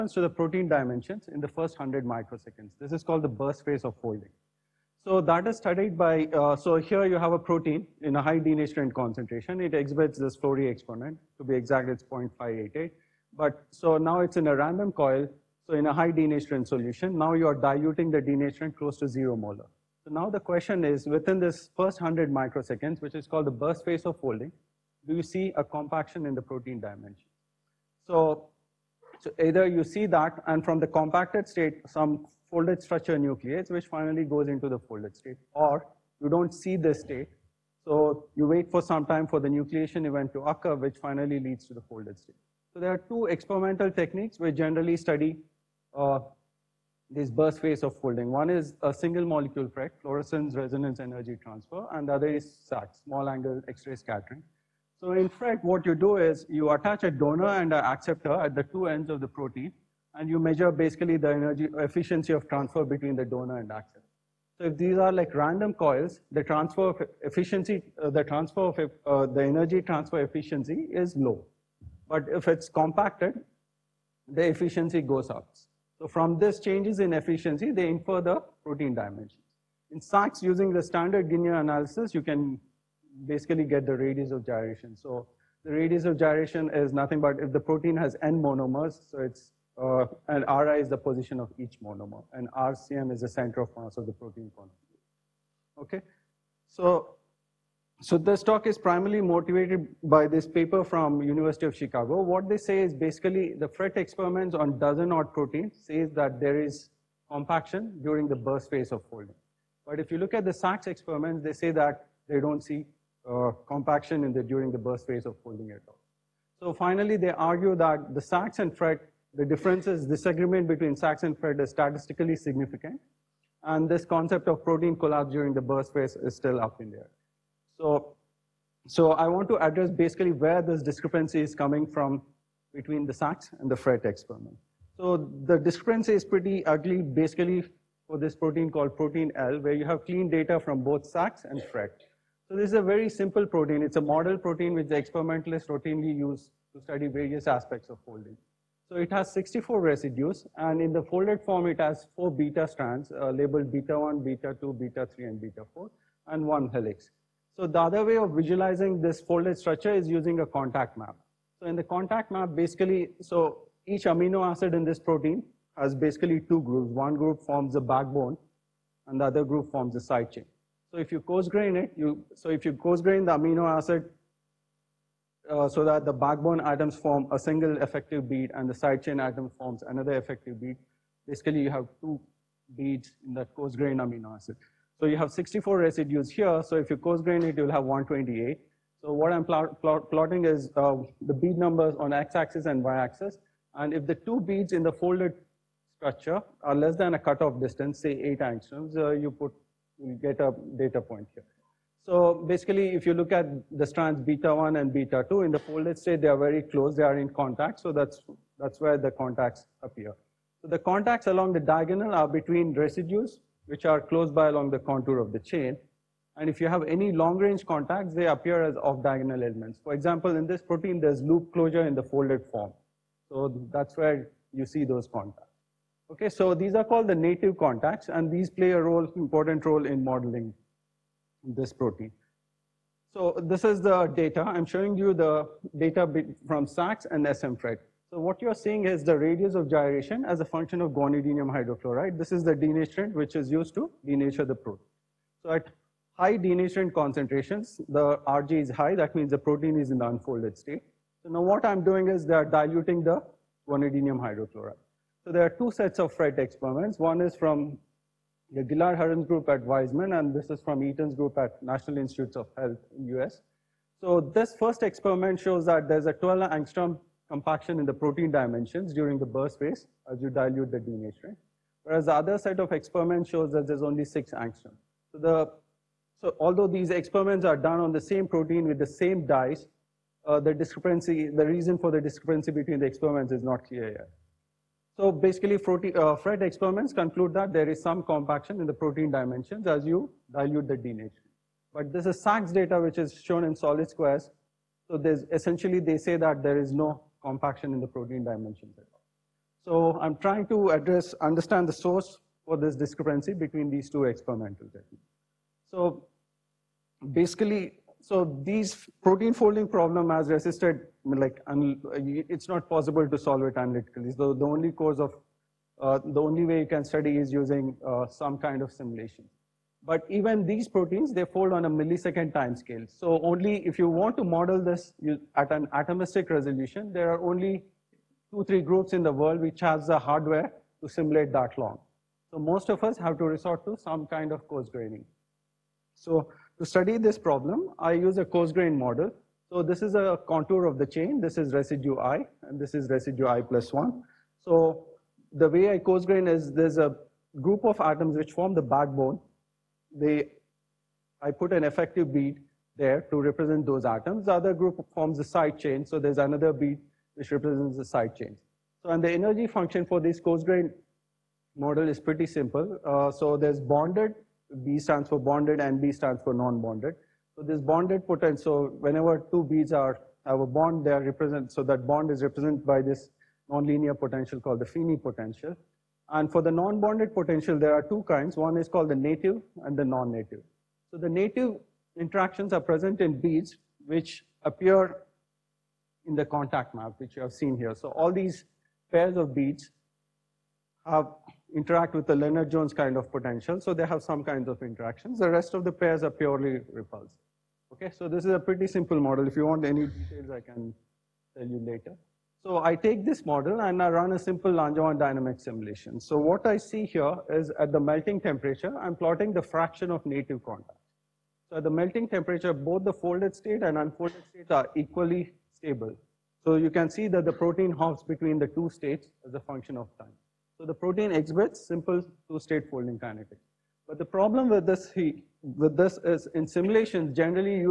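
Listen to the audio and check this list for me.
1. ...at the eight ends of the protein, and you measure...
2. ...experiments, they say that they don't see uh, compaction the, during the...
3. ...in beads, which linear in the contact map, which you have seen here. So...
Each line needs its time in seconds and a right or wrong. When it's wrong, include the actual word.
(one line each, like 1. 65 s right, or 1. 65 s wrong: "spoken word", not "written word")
1. 58 s wrong: "two", not "eight"
2. 110 s right
3. 382 s wrong: "appear", not "linear".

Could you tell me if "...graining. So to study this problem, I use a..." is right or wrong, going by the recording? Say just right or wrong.
right.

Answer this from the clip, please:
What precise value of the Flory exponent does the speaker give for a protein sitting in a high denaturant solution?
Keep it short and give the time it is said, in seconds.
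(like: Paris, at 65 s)
0.588, at 12 s.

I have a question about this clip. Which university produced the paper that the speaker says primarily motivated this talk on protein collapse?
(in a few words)
University of Chicago.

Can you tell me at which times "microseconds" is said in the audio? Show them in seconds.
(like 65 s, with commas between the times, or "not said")
2 s, 22 s.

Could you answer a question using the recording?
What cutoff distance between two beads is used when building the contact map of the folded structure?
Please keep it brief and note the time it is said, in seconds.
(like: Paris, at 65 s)
8 angstroms, at 198 s.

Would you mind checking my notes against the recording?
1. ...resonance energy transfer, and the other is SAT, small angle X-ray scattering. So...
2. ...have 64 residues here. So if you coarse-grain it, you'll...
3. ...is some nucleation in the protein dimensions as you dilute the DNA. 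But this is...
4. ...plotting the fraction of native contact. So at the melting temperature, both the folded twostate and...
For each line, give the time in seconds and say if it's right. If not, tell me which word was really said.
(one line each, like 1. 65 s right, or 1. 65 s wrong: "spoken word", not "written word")
1. 50 s right
2. 185 s right
3. 287 s wrong: "compaction", not "nucleation"
4. 408 s wrong: "state", not "twostate".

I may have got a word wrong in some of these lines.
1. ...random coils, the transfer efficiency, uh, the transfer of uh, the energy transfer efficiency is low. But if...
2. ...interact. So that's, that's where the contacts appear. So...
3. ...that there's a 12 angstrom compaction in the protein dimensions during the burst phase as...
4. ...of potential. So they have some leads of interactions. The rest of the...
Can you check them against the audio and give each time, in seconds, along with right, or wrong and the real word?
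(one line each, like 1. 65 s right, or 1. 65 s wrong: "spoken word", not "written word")
1. 65 s right
2. 207 s wrong: "contact", not "interact"
3. 265 s right
4. 392 s wrong: "kinds", not "leads".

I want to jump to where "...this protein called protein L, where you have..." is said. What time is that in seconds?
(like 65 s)
138 s.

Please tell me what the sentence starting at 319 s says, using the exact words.
But even these proteins, they fold on a millisecond time scale.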